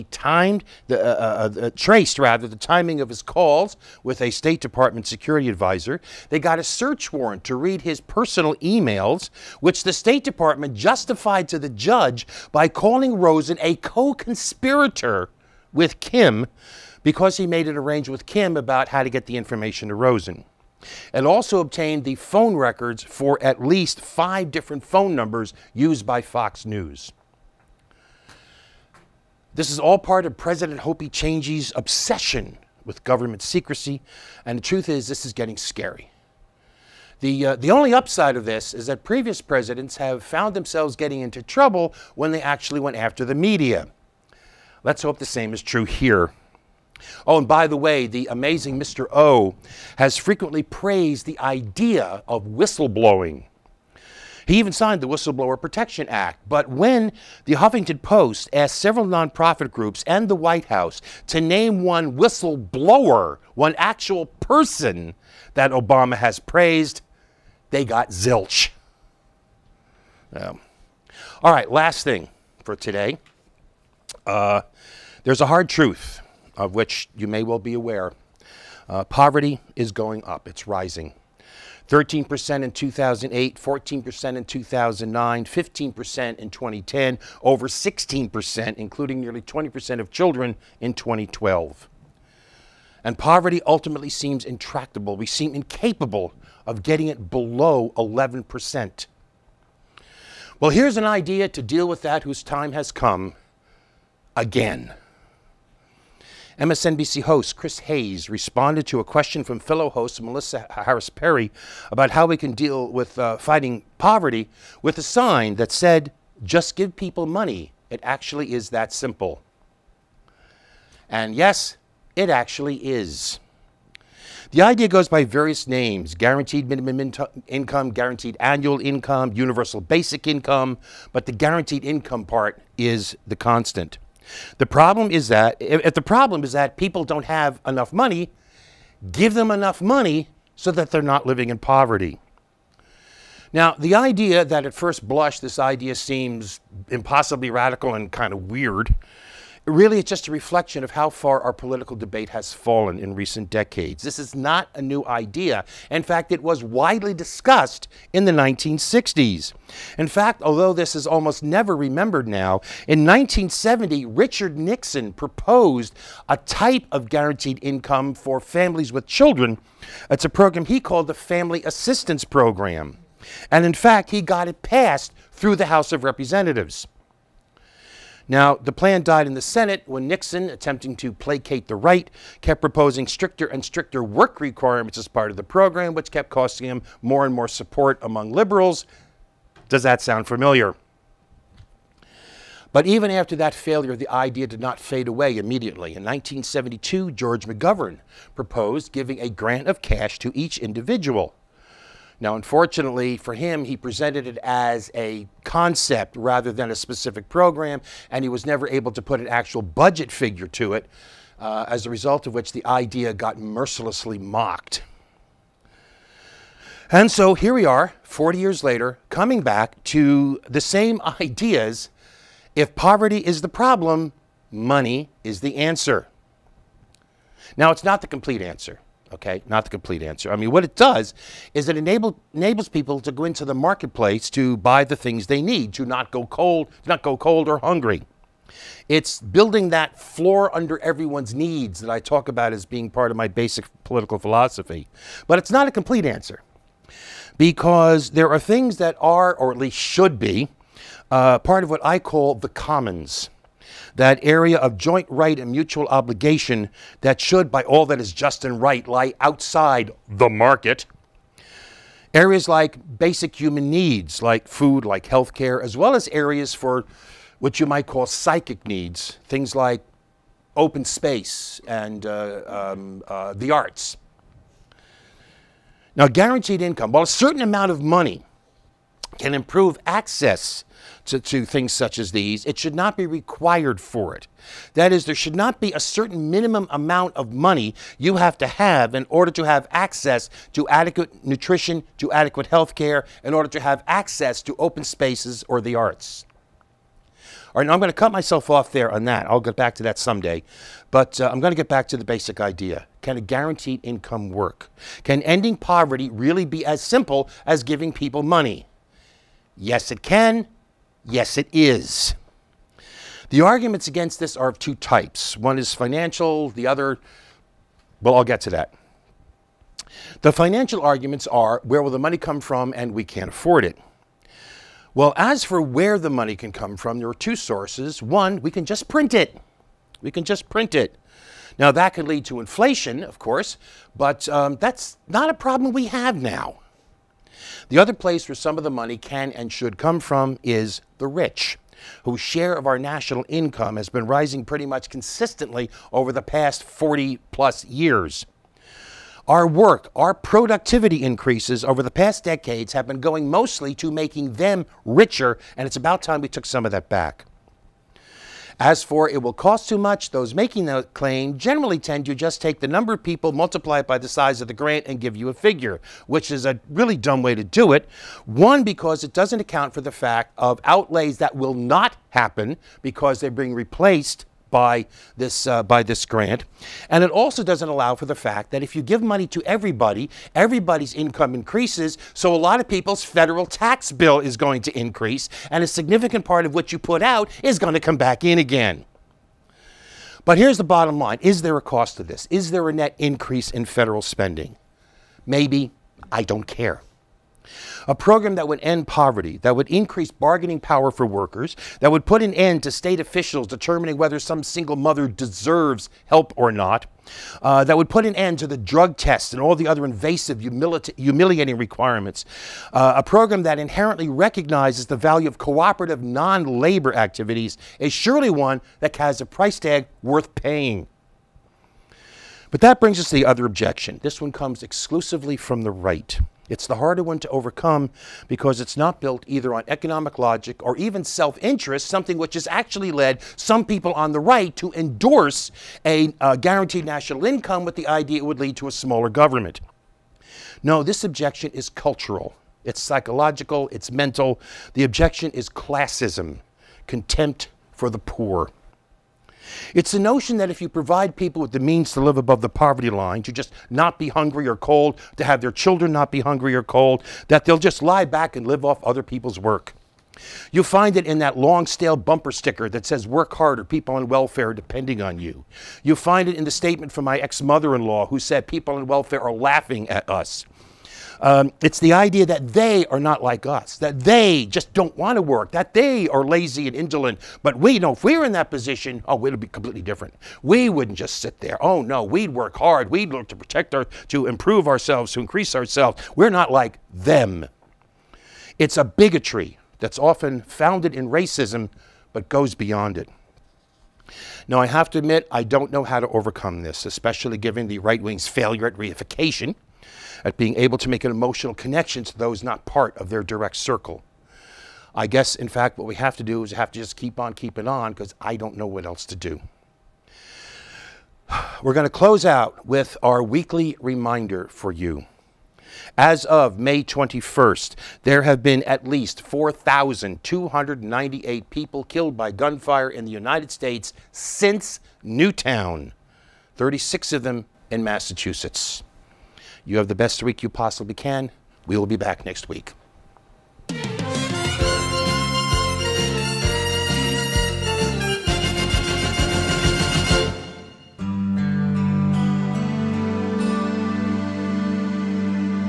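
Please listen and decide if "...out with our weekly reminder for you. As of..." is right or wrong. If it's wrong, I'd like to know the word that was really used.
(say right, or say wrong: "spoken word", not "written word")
right.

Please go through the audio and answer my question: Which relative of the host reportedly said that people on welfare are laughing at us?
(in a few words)
ex mother in law.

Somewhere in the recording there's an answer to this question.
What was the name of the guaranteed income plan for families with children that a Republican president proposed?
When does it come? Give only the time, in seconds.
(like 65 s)
171 s.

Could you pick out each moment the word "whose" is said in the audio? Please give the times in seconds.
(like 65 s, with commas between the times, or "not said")
102 s, 342 s.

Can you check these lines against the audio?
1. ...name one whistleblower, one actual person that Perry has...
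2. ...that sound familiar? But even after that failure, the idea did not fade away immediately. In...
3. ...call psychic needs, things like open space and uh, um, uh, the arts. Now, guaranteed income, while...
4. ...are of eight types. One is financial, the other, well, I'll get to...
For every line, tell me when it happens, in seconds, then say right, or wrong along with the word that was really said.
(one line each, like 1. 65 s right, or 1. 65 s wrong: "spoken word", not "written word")
1. 61 s wrong: "Obama", not "Perry"
2. 189 s right
3. 267 s right
4. 314 s wrong: "two", not "eight".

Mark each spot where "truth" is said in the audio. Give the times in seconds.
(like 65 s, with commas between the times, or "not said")
34 s, 75 s.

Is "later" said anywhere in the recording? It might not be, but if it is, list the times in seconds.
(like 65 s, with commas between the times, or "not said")
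218 s.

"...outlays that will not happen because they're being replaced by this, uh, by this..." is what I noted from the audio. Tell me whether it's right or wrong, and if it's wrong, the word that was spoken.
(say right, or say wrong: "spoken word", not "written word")
right.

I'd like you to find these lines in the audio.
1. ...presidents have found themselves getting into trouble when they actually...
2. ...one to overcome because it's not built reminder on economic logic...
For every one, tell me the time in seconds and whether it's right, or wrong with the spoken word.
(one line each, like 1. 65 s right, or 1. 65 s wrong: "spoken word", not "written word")
1. 39 s right
2. 427 s wrong: "either", not "reminder".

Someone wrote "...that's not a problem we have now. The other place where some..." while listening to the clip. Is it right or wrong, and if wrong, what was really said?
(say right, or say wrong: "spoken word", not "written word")
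right.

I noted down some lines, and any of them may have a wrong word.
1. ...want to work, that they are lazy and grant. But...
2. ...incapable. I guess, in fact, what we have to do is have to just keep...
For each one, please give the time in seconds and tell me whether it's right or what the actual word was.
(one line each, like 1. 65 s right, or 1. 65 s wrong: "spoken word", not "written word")
1. 474 s wrong: "indolent", not "grant"
2. 503 s wrong: "circle", not "incapable".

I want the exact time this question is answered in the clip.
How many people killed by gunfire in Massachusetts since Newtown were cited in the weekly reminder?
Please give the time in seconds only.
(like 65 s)
526 s.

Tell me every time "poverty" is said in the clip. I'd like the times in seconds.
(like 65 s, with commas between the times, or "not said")
79 s, 93 s, 113 s, 141 s, 222 s, 305 s, 398 s, 452 s.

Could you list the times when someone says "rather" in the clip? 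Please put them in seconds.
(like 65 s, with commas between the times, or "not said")
2 s, 206 s.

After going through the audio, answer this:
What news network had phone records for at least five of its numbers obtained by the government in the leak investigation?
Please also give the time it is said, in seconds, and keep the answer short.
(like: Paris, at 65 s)
Fox News, at 26 s.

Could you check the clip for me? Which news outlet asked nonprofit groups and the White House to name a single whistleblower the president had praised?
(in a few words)
Huffington Post.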